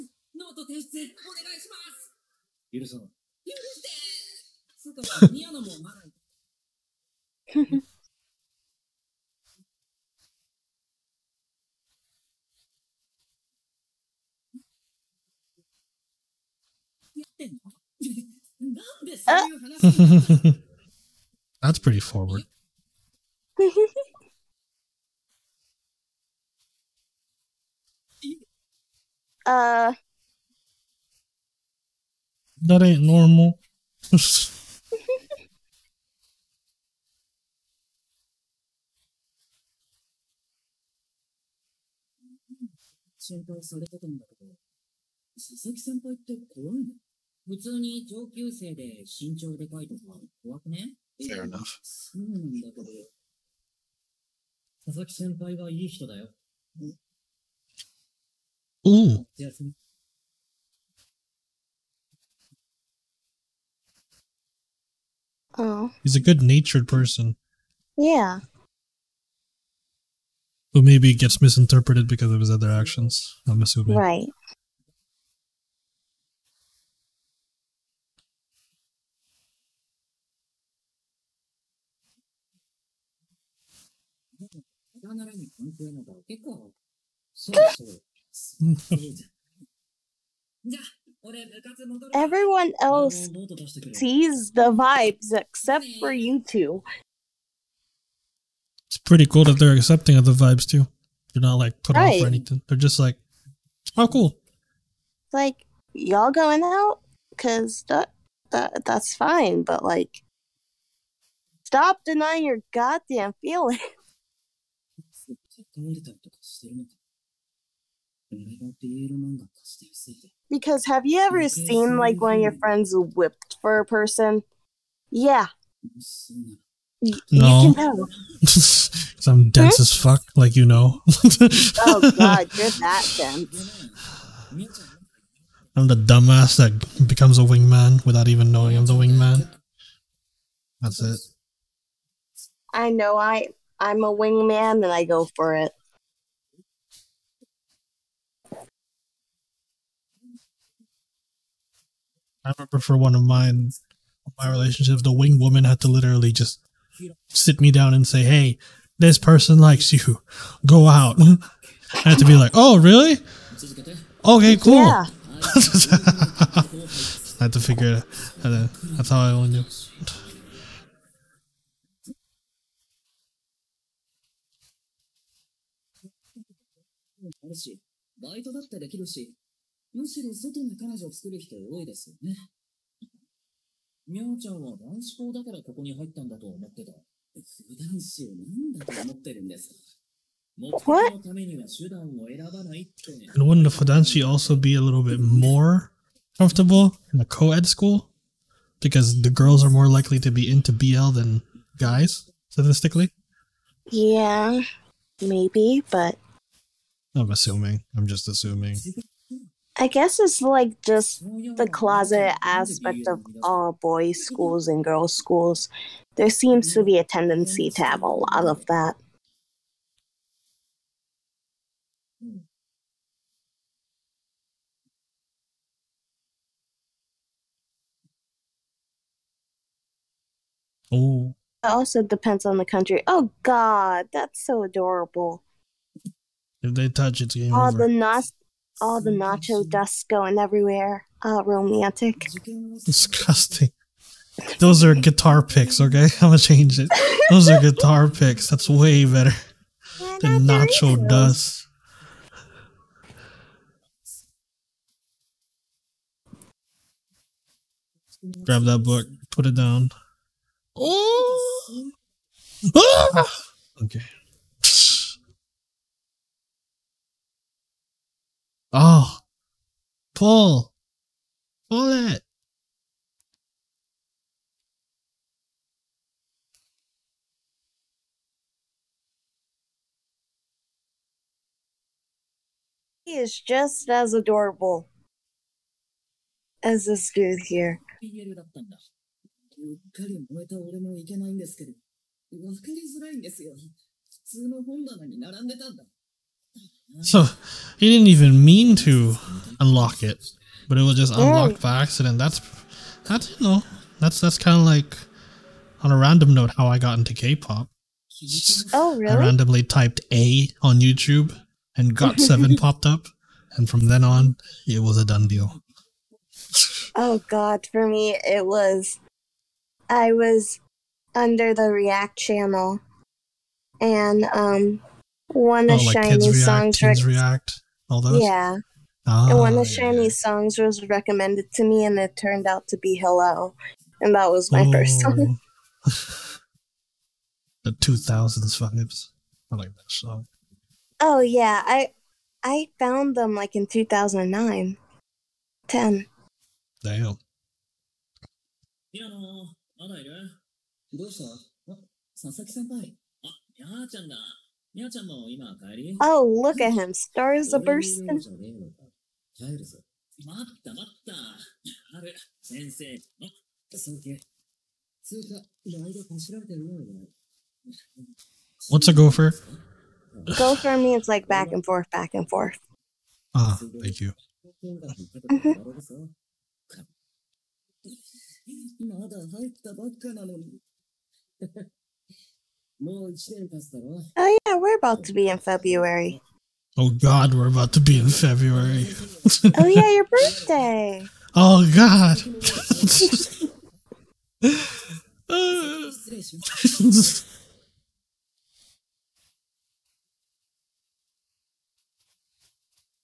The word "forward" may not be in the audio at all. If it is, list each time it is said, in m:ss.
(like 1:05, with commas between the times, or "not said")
0:22.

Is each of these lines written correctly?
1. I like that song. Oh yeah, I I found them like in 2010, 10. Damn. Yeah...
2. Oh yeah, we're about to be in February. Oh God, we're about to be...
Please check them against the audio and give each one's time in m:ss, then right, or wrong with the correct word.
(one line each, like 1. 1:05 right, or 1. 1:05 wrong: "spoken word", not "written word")
1. 5:39 wrong: "2009", not "2010"
2. 6:22 right.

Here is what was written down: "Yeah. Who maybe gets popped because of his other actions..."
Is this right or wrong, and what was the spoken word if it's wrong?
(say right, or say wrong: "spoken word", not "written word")
wrong: "misinterpreted", not "popped".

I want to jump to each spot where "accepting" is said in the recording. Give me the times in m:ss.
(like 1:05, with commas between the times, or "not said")
1:39.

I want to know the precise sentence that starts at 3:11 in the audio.
And wouldn't the Fudanshi also be a little bit more comfortable in a co-ed school?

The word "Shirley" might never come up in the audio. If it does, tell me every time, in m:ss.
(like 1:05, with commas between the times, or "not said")
not said.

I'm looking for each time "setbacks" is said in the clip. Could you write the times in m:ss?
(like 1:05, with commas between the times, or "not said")
not said.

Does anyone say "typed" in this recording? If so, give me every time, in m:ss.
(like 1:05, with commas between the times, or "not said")
5:09.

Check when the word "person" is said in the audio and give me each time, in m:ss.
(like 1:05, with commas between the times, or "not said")
1:06, 2:03, 2:39.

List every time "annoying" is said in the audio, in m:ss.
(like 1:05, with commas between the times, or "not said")
not said.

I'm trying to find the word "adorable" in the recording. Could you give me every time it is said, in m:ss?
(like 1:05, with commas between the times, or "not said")
3:54, 4:44.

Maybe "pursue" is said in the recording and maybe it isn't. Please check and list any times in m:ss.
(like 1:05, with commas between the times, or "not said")
not said.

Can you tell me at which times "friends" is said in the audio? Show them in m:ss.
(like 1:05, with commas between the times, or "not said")
2:02.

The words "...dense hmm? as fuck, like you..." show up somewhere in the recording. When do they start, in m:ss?
2:09.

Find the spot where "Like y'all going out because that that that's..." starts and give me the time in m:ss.
1:45.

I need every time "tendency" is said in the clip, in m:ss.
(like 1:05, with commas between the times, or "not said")
3:37.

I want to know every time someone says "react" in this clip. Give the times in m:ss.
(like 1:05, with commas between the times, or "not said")
5:21, 5:27.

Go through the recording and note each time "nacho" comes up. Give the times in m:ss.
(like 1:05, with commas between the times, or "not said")
3:59, 4:10.